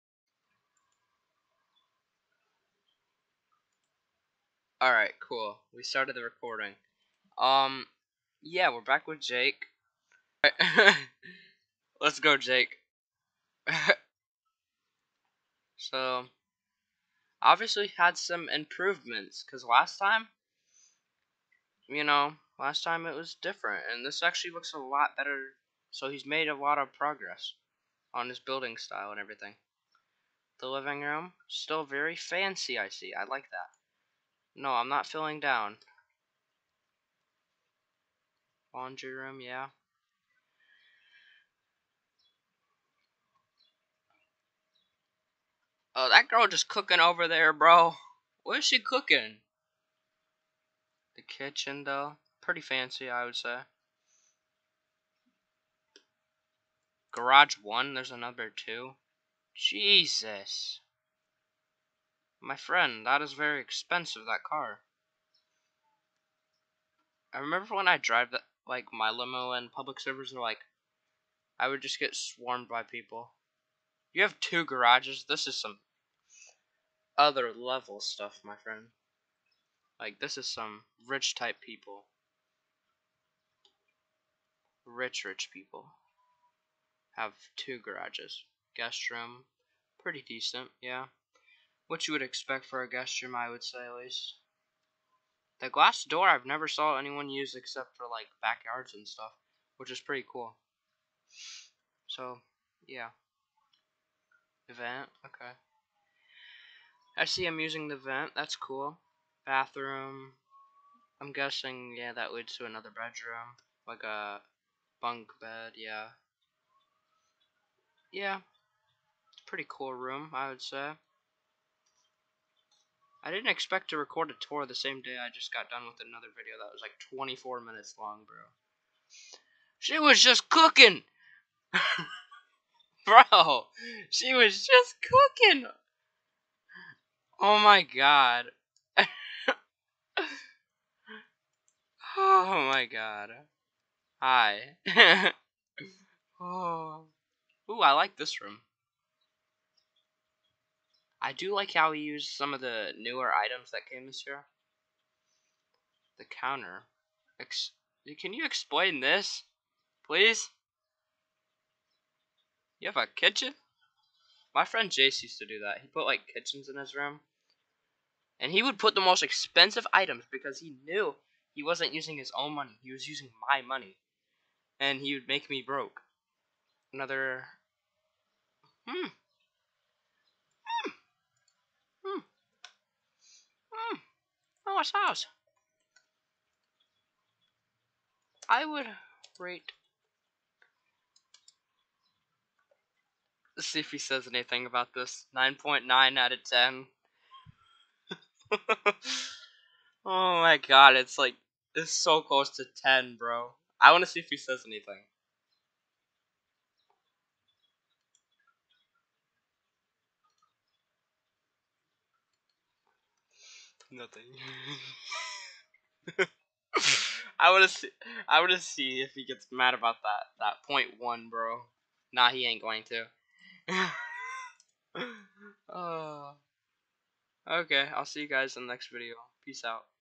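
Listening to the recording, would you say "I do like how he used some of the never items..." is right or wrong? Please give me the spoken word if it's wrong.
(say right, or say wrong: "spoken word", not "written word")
wrong: "newer", not "never".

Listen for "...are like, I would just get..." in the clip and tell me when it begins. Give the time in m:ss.
1:10.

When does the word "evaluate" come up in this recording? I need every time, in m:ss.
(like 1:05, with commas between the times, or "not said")
not said.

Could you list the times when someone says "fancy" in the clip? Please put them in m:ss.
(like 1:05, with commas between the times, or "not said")
0:32, 0:52.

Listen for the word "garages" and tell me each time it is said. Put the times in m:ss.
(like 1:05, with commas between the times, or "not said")
0:57, 1:14, 1:27.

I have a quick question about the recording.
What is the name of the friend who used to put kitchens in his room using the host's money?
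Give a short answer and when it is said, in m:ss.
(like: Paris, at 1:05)
Jace, at 2:44.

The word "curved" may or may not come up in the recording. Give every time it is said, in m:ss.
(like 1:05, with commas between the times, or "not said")
not said.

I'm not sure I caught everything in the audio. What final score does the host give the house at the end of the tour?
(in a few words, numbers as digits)
9.9 out of 10.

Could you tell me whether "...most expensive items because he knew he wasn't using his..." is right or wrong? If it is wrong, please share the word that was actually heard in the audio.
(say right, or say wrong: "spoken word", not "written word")
right.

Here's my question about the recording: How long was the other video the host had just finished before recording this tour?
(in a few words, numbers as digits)
24 minutes.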